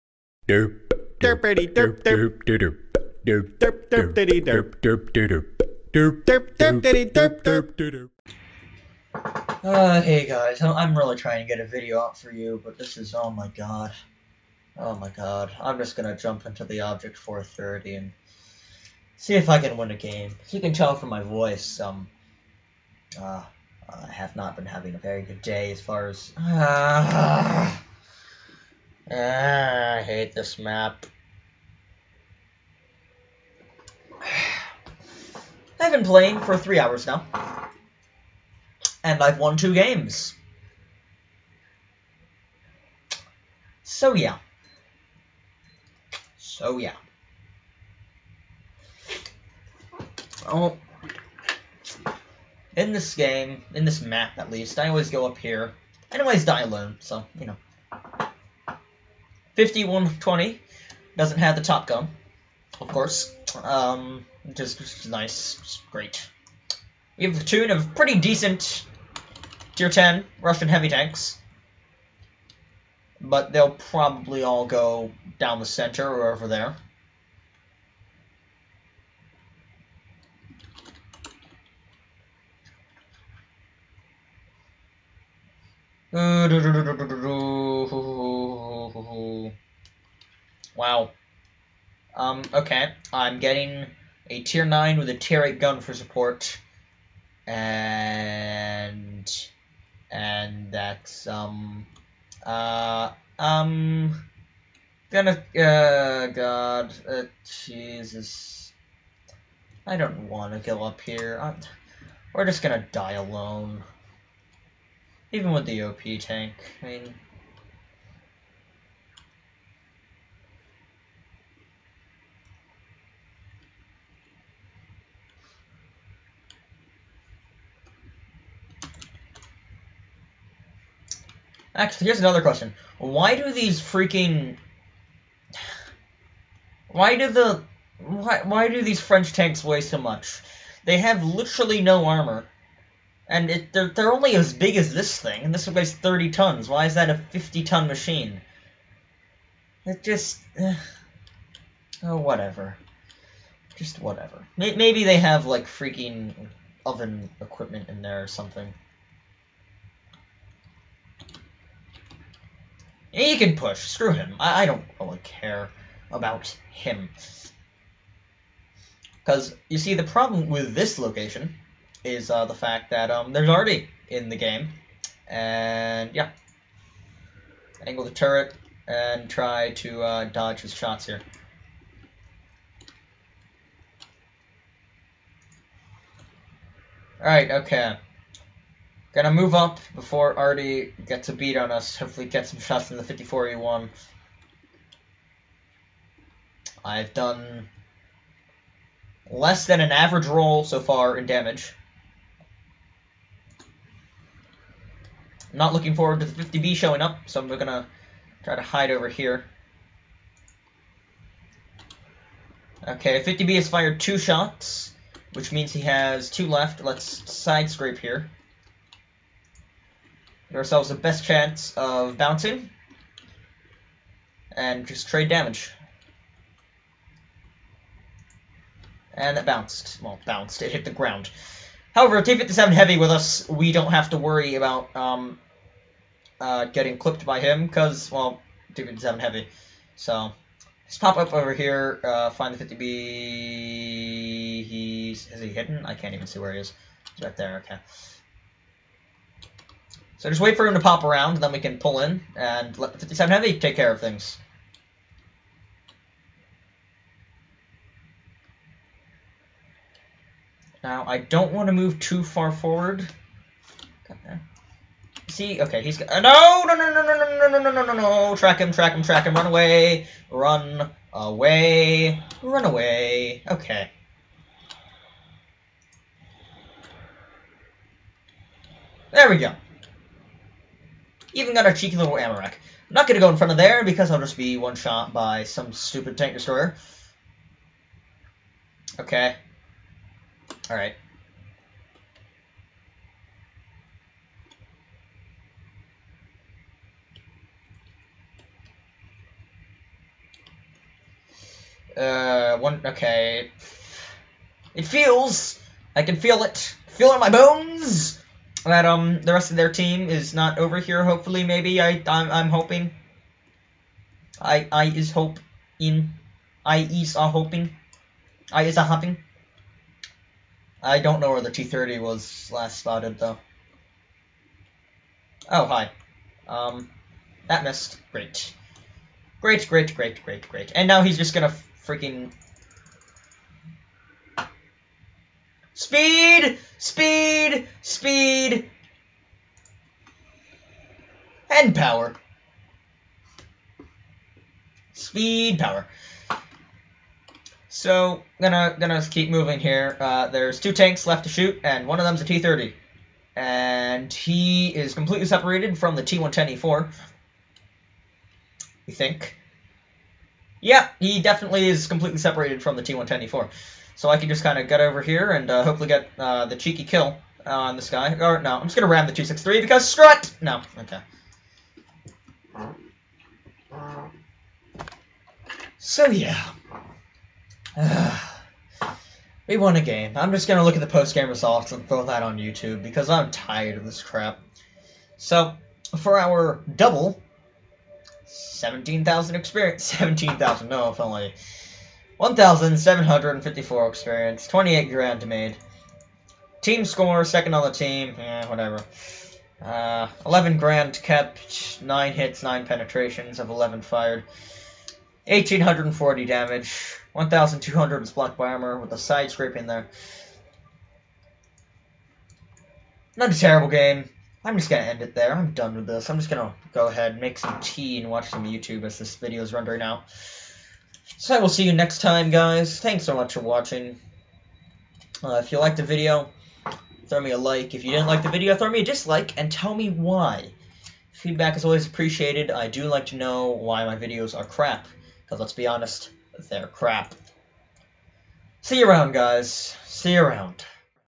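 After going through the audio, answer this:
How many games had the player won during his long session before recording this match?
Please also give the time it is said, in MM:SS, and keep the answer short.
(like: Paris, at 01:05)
2, at 00:39.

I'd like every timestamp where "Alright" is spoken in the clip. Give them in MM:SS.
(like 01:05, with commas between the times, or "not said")
03:07, 04:50.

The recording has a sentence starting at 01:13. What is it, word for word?
But they'll probably all go down the center or over there.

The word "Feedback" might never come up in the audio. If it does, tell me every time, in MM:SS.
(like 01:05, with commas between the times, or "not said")
07:11.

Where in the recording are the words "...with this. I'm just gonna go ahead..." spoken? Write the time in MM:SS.
06:55.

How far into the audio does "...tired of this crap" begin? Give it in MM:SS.
06:23.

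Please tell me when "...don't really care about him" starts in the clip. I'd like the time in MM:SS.
02:44.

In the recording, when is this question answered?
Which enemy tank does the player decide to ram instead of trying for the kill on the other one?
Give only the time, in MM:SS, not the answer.
06:09.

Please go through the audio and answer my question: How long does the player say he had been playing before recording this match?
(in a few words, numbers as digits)
three hours.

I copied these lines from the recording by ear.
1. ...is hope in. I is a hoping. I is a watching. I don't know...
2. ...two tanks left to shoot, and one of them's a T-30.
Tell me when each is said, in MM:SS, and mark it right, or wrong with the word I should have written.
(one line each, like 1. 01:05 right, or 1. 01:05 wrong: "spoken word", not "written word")
1. 05:14 wrong: "hopping", not "watching"
2. 05:50 right.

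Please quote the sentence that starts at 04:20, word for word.
Now, I don't want to move too far forward.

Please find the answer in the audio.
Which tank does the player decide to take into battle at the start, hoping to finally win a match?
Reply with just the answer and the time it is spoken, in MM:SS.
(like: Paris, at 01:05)
Object 430, at 00:16.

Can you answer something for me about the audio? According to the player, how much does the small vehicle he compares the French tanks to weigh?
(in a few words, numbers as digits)
30 tons.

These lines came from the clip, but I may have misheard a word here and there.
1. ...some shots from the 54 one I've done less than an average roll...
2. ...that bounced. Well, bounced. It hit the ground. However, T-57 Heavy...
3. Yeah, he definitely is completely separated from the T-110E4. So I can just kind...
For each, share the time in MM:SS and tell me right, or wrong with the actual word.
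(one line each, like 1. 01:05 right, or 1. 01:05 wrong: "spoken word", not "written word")
1. 03:12 right
2. 03:49 right
3. 06:00 right.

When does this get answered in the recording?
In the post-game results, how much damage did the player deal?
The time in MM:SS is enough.
06:45.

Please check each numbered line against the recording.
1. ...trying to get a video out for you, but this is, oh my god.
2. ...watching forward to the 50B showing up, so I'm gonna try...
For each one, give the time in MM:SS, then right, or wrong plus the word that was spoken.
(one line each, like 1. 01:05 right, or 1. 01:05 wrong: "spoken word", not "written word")
1. 00:11 right
2. 03:25 wrong: "looking", not "watching".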